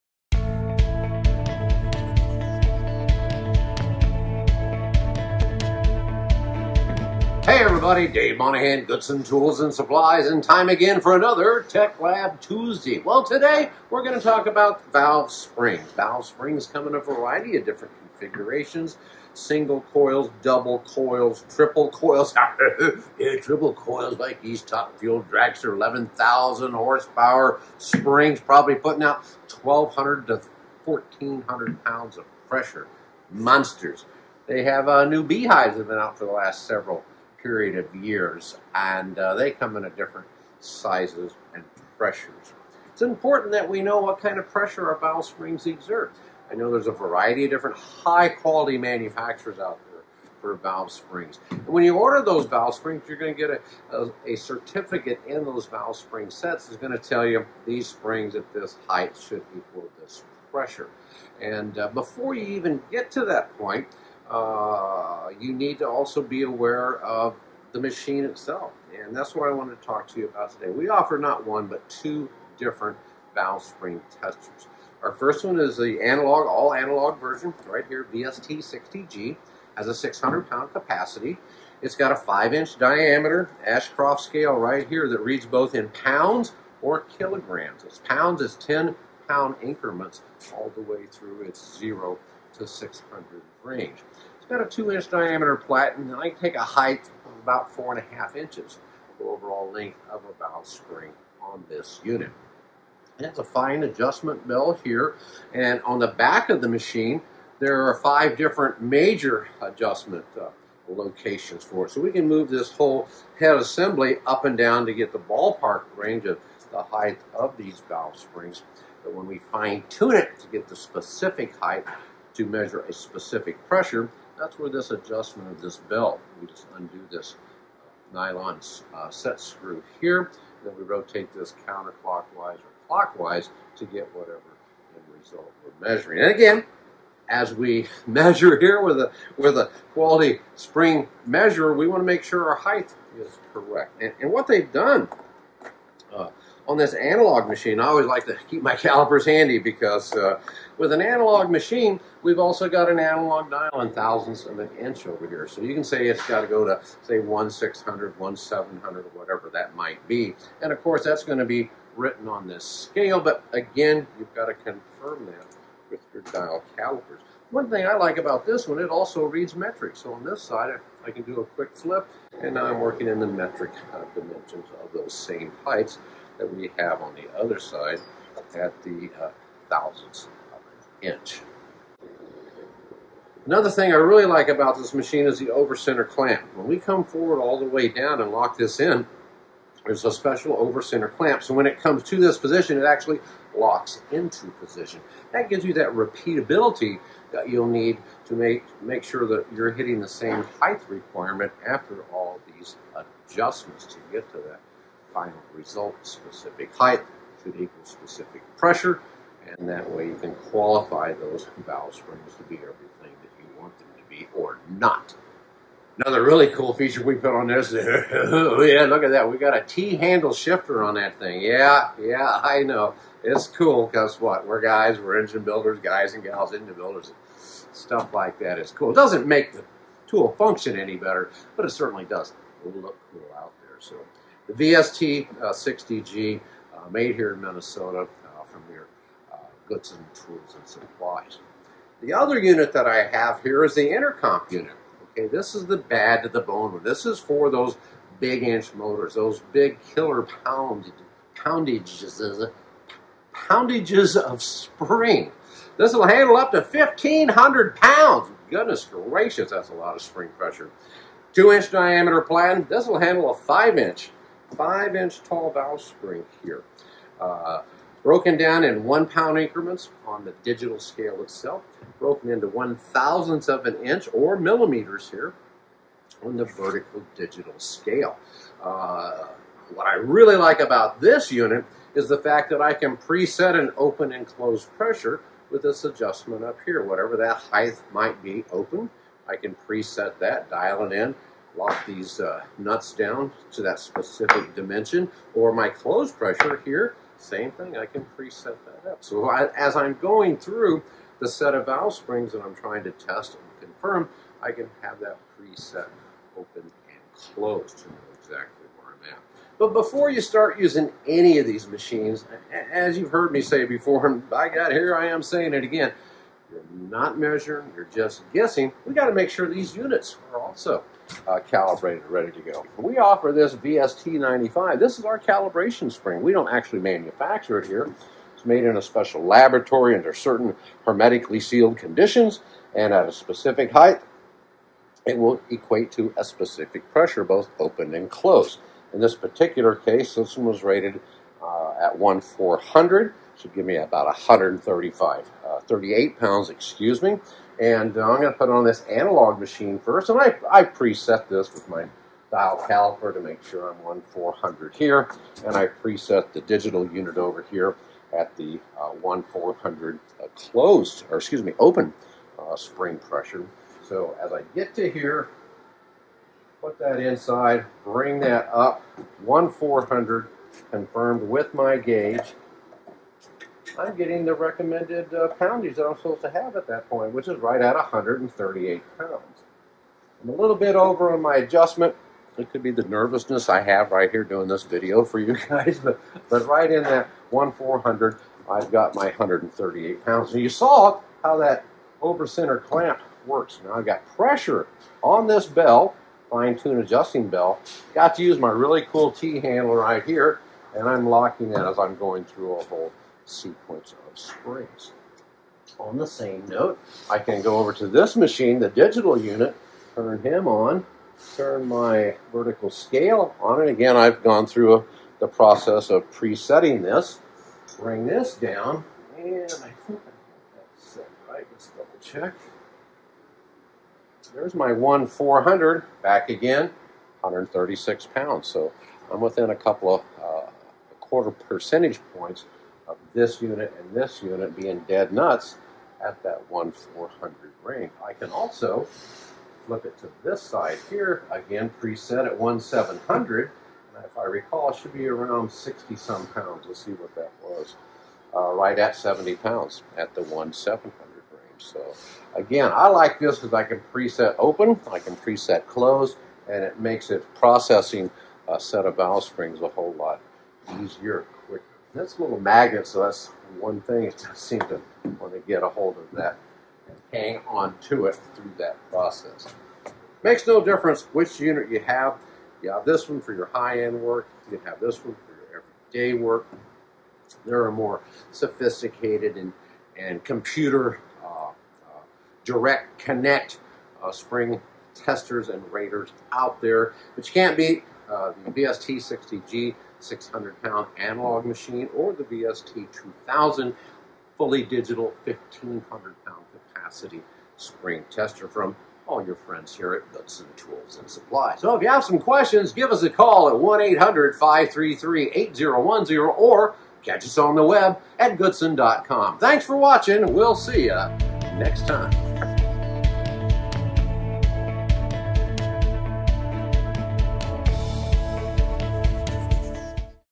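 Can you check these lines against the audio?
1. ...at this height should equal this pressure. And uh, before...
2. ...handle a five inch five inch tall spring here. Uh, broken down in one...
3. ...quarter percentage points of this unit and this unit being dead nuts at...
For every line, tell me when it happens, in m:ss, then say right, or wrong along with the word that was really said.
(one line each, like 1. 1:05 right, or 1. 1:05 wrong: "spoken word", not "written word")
1. 0:58 right
2. 4:22 right
3. 7:11 right.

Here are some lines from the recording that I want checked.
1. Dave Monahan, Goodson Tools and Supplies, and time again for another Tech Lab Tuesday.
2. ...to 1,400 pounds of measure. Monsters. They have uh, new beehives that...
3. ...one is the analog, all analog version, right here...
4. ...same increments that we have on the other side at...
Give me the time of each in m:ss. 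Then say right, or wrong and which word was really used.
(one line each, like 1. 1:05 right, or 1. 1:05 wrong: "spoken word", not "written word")
1. 0:08 right
2. 0:30 wrong: "pressure", not "measure"
3. 1:15 right
4. 2:55 wrong: "heights", not "increments".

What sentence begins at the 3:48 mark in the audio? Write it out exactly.
It doesn't make the tool function any better, but it certainly does look cool out there.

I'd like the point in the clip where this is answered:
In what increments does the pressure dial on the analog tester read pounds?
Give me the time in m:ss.
1:28.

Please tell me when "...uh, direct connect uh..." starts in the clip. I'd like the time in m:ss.
8:01.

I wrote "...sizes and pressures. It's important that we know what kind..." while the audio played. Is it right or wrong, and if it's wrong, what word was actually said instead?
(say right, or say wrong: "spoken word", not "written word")
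right.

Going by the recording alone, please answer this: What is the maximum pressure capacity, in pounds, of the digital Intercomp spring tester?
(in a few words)
1,500 pounds.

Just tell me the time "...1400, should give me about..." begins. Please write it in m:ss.
5:41.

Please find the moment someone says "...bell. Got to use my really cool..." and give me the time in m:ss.
6:37.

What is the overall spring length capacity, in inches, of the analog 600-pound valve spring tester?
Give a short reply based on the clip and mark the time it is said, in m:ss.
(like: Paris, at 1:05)
4.5 inches, at 1:37.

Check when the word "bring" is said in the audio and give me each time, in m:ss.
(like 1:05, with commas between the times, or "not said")
6:07, 6:57.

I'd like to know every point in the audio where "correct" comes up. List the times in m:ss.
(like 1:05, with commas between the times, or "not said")
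2:23.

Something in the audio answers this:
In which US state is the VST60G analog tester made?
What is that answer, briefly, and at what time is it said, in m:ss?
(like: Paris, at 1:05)
Minnesota, at 3:57.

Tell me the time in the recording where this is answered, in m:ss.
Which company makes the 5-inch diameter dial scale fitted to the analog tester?
1:23.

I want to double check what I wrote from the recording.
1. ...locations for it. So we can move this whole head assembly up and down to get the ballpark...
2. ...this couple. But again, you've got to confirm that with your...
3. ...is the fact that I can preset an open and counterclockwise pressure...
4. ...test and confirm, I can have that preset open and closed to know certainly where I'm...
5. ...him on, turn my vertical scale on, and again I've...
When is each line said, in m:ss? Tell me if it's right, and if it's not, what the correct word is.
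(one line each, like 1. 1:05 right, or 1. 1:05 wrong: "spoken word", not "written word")
1. 1:50 right
2. 2:42 wrong: "scale", not "couple"
3. 4:41 wrong: "close", not "counterclockwise"
4. 5:02 wrong: "exactly", not "certainly"
5. 6:50 right.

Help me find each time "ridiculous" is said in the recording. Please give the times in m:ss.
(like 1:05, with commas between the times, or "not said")
not said.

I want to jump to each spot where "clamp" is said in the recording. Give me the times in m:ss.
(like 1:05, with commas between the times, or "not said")
3:06, 3:11, 6:32.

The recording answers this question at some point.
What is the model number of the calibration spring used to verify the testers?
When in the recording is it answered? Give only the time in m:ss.
5:23.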